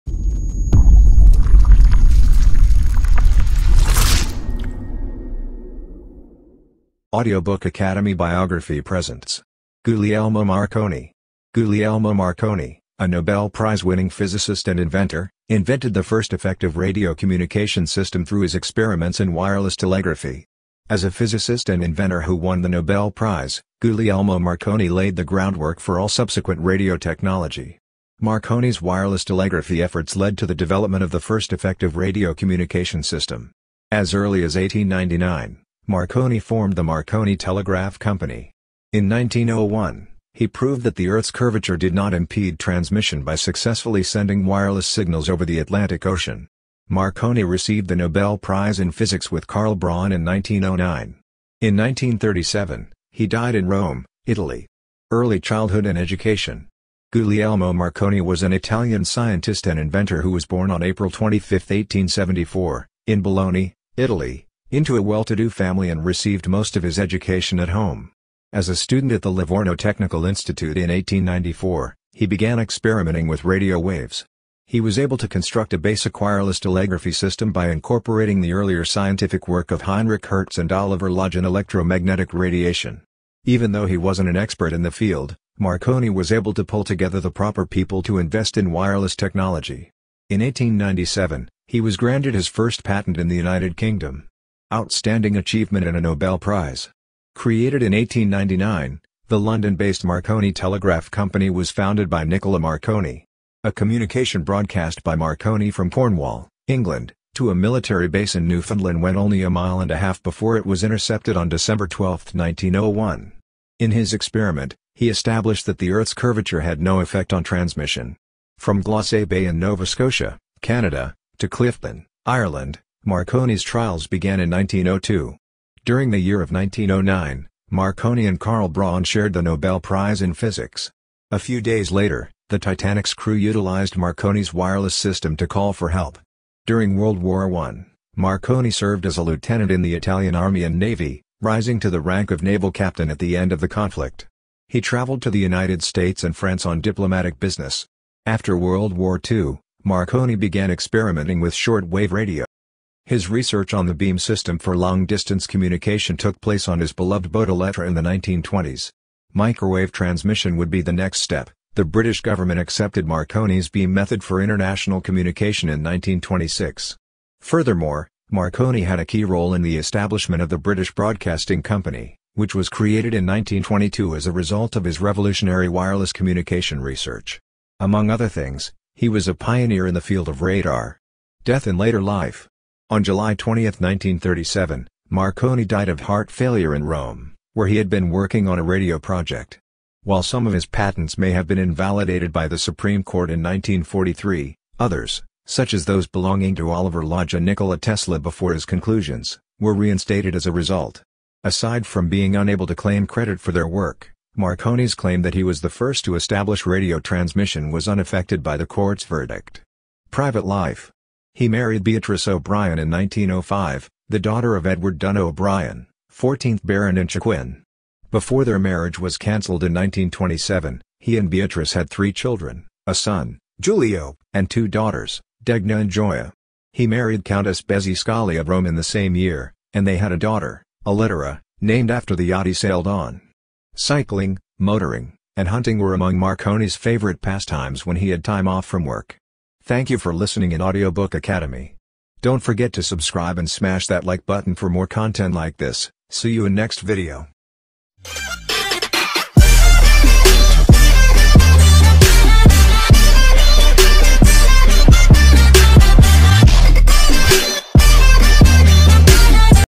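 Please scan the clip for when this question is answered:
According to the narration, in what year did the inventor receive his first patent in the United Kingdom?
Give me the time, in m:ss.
1:30.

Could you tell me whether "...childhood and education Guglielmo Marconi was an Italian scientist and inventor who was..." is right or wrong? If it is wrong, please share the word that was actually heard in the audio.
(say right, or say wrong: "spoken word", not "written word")
right.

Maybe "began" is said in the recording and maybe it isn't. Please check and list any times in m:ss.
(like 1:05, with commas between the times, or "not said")
1:12, 2:04, 2:30.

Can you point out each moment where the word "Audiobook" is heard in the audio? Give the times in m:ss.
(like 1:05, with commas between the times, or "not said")
0:07, 4:00.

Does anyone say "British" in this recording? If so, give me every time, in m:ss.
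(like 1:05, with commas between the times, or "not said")
2:41, 2:50.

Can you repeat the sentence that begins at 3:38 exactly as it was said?
Before their marriage was cancelled in 1927, he and Beatrice had three children, a son, Giulio, and two daughters, Degna and Gioia.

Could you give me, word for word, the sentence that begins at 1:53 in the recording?
In his experiment, he established that the Earth's curvature had no effect on transmission.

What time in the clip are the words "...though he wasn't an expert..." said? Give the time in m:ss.
1:23.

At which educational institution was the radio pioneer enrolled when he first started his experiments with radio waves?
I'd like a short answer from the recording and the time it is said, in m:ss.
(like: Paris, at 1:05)
Livorno Technical Institute, at 1:09.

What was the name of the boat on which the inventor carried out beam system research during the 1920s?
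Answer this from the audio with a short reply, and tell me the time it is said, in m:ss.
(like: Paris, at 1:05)
Electra, at 2:37.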